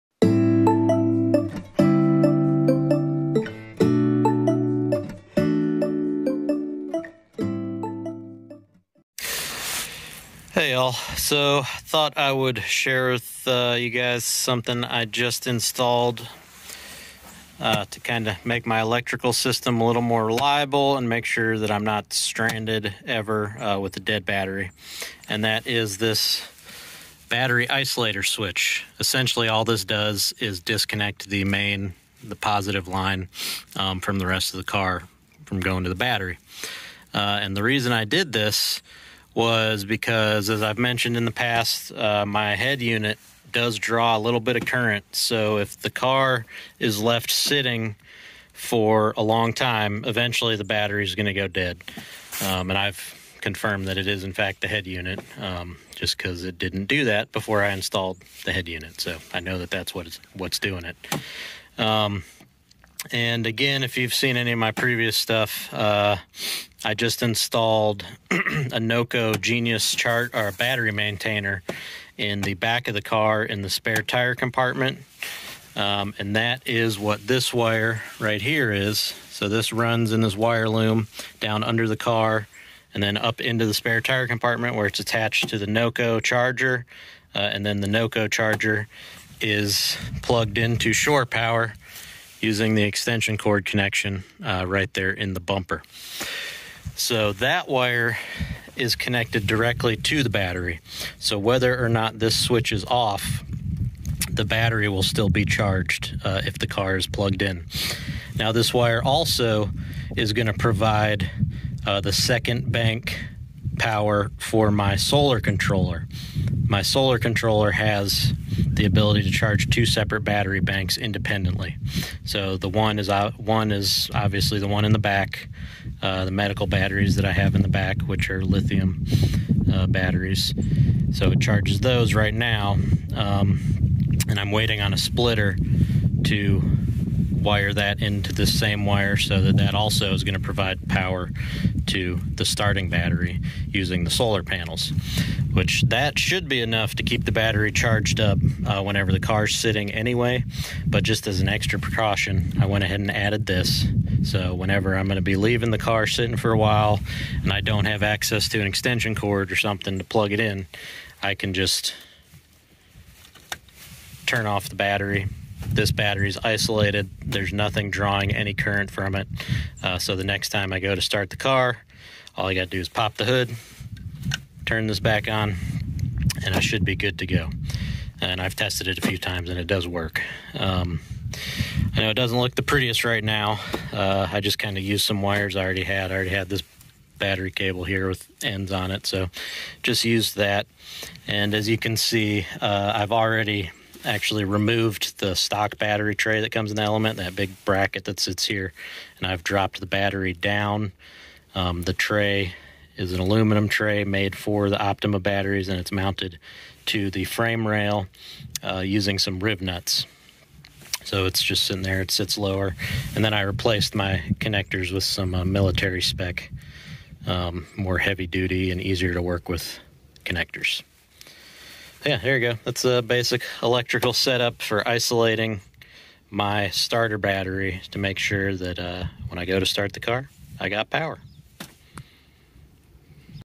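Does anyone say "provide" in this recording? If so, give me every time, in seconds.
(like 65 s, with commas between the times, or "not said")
110 s, 140 s.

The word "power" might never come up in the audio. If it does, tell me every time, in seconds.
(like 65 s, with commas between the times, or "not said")
91 s, 113 s, 140 s, 230 s.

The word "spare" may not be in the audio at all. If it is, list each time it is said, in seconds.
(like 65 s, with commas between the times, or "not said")
73 s, 83 s.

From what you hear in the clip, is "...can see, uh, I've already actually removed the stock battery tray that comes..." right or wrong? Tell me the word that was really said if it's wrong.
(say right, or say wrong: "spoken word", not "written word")
right.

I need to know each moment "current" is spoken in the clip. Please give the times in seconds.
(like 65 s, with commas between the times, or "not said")
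44 s, 168 s.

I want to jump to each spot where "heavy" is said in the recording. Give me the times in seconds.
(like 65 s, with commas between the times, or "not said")
217 s.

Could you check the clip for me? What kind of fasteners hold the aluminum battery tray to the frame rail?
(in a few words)
rivnuts.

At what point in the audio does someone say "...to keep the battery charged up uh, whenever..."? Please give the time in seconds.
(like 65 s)
146 s.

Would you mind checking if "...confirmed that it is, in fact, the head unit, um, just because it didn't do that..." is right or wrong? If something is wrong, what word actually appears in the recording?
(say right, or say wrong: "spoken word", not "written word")
right.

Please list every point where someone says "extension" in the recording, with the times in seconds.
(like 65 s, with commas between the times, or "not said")
92 s, 158 s.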